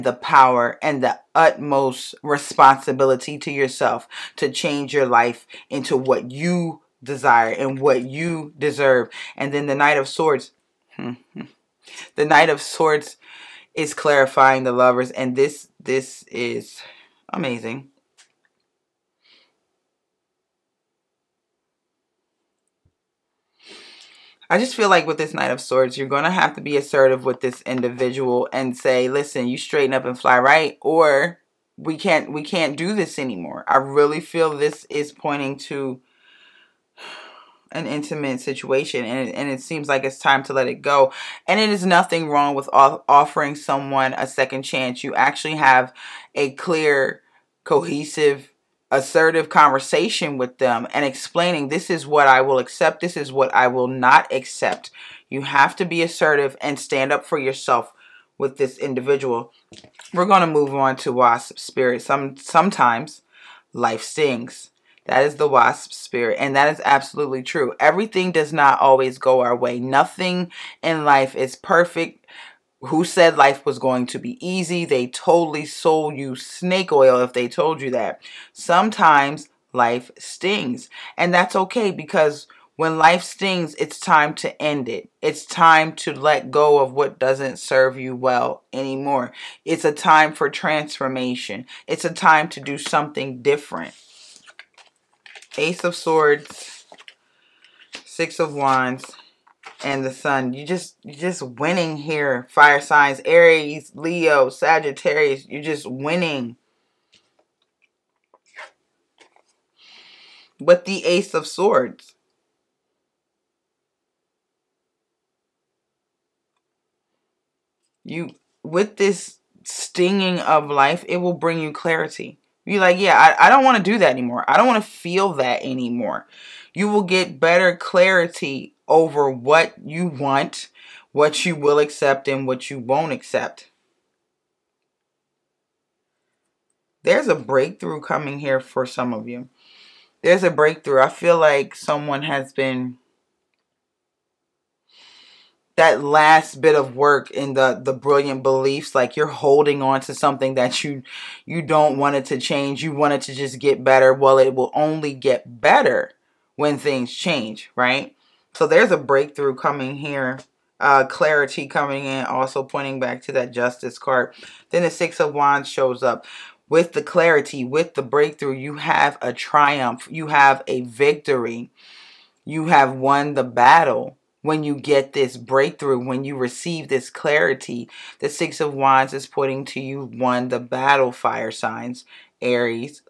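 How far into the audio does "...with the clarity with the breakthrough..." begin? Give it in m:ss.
2:46.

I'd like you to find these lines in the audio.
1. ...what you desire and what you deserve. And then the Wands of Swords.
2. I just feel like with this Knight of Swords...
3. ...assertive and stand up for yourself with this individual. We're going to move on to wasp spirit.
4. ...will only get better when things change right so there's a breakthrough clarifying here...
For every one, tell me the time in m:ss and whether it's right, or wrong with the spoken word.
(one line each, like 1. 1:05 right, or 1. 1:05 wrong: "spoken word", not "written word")
1. 0:05 wrong: "Knight", not "Wands"
2. 0:24 right
3. 0:56 right
4. 2:34 wrong: "coming", not "clarifying".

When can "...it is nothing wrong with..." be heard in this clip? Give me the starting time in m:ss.
0:41.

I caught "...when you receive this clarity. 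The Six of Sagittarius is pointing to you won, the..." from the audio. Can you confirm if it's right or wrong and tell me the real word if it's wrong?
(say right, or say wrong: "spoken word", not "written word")
wrong: "Wands", not "Sagittarius".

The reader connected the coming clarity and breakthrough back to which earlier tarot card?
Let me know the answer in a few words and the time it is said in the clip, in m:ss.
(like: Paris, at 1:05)
Justice, at 2:43.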